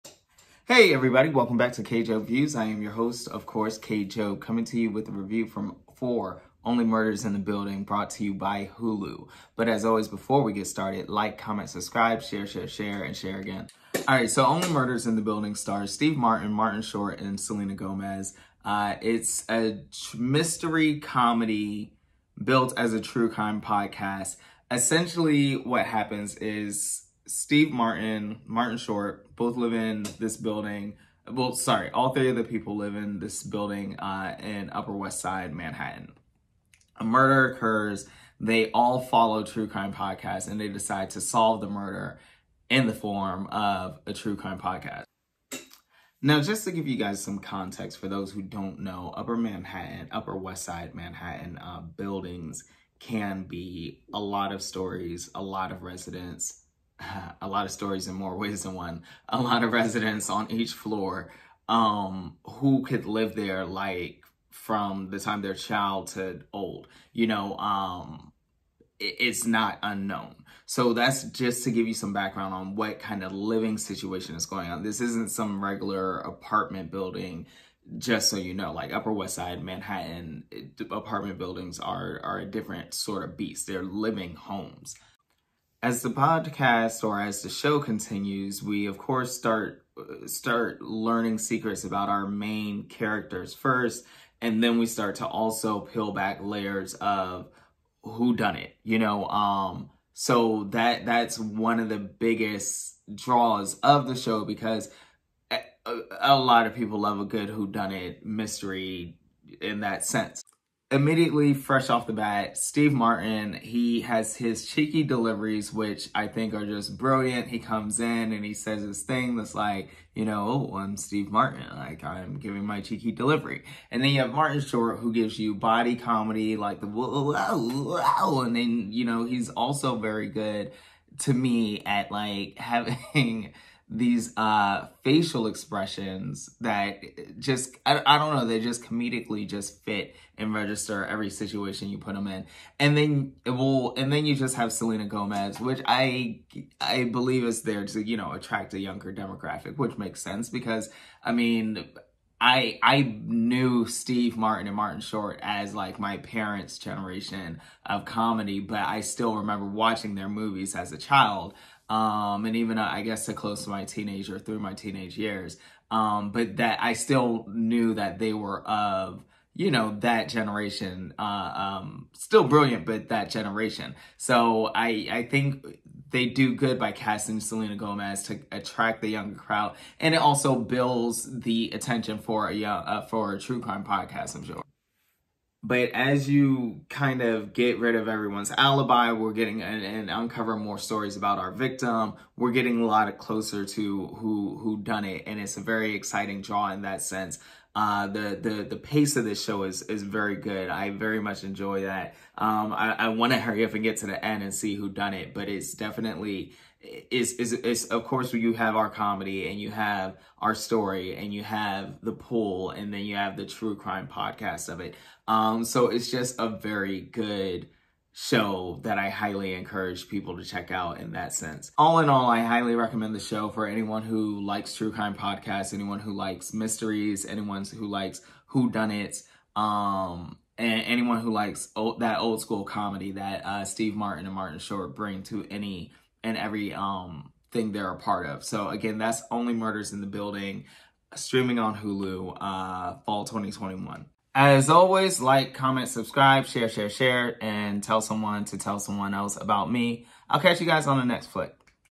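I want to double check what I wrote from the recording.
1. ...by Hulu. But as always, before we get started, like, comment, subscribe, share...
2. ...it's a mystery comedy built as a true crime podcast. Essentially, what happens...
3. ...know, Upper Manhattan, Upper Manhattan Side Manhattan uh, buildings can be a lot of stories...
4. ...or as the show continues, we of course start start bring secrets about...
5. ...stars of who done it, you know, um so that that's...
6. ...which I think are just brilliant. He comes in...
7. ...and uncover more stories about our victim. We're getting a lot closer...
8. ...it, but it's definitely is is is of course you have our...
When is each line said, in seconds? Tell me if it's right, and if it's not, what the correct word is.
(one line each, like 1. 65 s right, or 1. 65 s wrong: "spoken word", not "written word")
1. 8 s right
2. 19 s right
3. 48 s wrong: "West", not "Manhattan"
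4. 87 s wrong: "learning", not "bring"
5. 96 s wrong: "layers", not "stars"
6. 115 s right
7. 189 s right
8. 205 s right.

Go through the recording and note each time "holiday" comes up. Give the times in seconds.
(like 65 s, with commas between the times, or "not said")
not said.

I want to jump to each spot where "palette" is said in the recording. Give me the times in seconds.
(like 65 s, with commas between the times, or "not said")
not said.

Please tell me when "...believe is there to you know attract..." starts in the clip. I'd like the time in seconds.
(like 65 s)
147 s.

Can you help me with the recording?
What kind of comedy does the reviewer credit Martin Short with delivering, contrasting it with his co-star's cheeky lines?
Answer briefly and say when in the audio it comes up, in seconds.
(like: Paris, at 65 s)
Body comedy, at 125 s.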